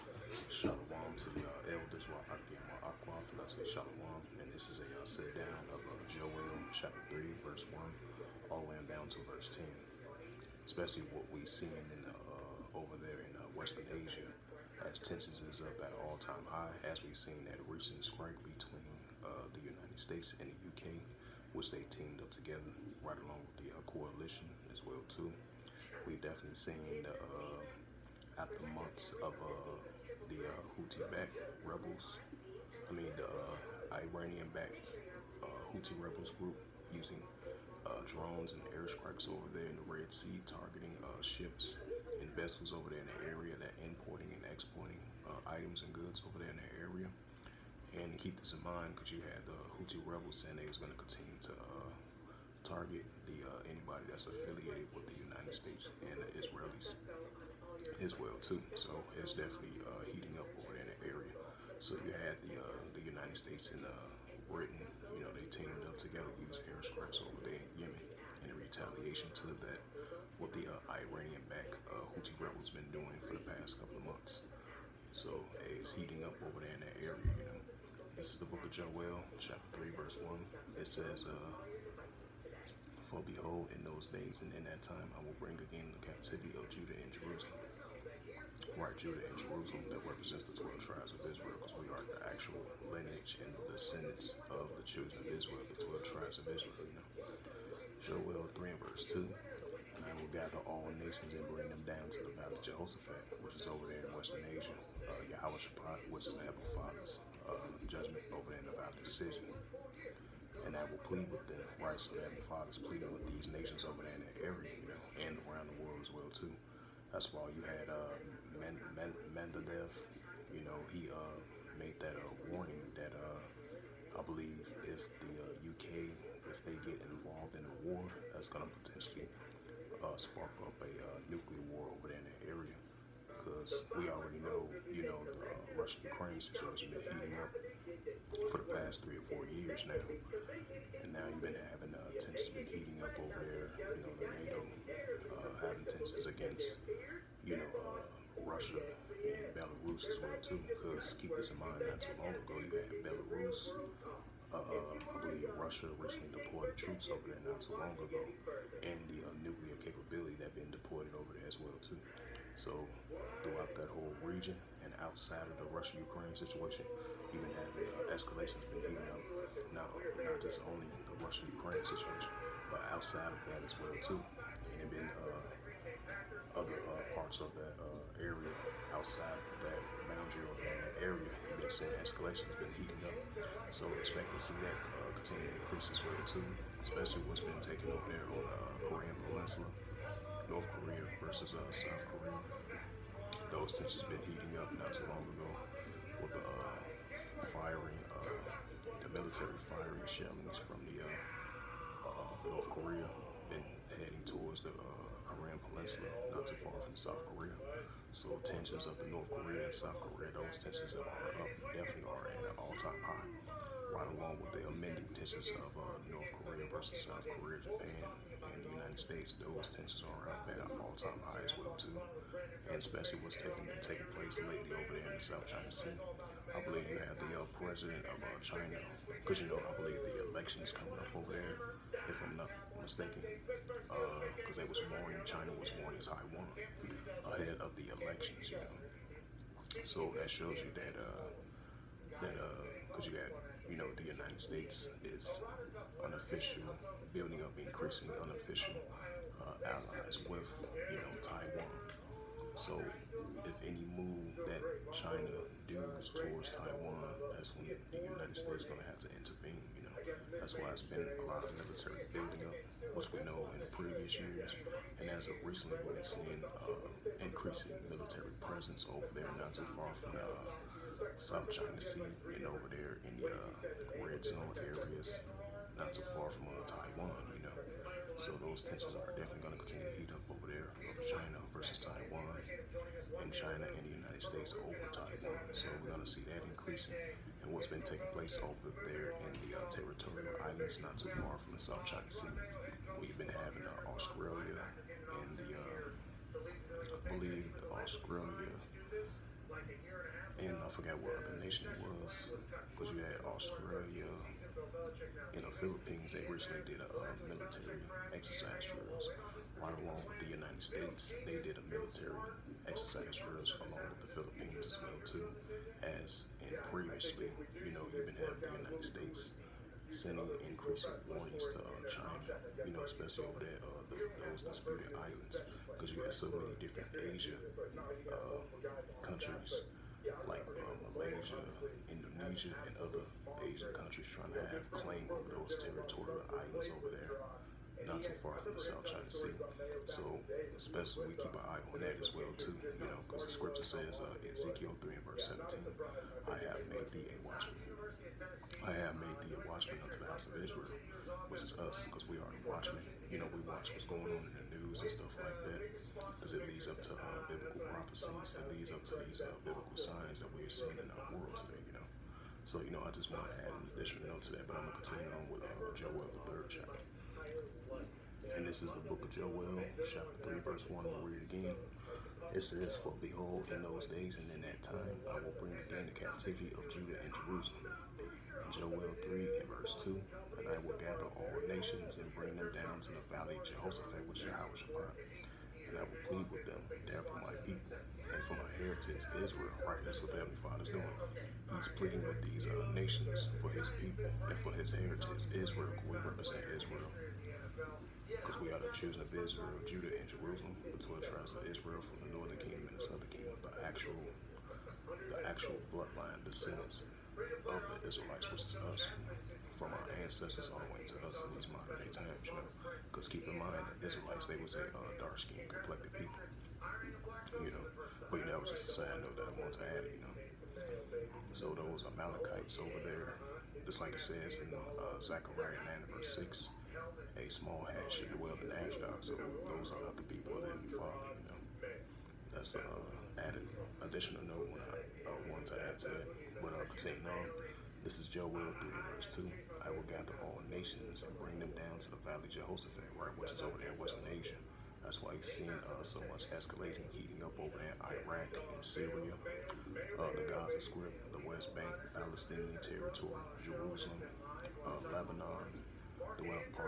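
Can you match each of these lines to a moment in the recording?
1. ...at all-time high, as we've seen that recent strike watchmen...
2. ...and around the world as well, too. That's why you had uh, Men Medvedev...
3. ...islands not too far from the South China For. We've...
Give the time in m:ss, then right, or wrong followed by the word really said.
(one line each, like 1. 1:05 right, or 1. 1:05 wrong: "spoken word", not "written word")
1. 0:15 wrong: "between", not "watchmen"
2. 1:55 right
3. 4:50 wrong: "Sea", not "For".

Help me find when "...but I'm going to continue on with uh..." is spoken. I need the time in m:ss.
6:04.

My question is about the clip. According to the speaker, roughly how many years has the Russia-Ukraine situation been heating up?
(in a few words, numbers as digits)
3 or 4 years.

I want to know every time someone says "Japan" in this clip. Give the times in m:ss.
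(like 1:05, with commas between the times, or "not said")
3:37.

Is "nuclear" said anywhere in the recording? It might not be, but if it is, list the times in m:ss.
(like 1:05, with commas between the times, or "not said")
2:11, 2:39.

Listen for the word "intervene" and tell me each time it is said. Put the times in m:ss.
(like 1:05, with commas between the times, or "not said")
4:19.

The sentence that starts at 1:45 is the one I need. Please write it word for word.
Uh, Yahweh Shabbat, which is the Heavenly Father's uh, judgment over an ungodly decision.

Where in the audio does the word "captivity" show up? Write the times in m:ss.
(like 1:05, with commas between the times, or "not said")
1:26, 6:15.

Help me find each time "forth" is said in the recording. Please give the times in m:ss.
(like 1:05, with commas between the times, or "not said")
not said.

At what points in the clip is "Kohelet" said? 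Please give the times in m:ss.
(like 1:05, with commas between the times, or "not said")
not said.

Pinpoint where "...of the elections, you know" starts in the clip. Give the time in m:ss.
3:57.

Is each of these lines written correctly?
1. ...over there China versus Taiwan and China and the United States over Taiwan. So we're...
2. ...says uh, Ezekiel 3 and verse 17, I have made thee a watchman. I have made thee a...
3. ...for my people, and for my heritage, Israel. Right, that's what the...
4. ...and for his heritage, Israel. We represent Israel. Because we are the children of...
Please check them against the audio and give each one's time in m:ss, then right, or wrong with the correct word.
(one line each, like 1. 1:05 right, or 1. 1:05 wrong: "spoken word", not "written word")
1. 4:40 right
2. 5:43 right
3. 6:27 right
4. 6:34 right.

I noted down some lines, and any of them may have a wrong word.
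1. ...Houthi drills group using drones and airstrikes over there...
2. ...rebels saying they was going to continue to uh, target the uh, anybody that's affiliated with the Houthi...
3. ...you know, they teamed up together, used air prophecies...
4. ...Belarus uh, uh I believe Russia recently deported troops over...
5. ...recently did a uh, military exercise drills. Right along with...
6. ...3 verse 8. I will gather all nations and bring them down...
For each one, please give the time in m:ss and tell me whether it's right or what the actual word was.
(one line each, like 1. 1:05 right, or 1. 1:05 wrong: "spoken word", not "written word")
1. 0:35 wrong: "rebels", not "drills"
2. 0:50 wrong: "United", not "Houthi"
3. 1:05 wrong: "strikes", not "prophecies"
4. 2:33 right
5. 5:06 right
6. 7:18 wrong: "2", not "8".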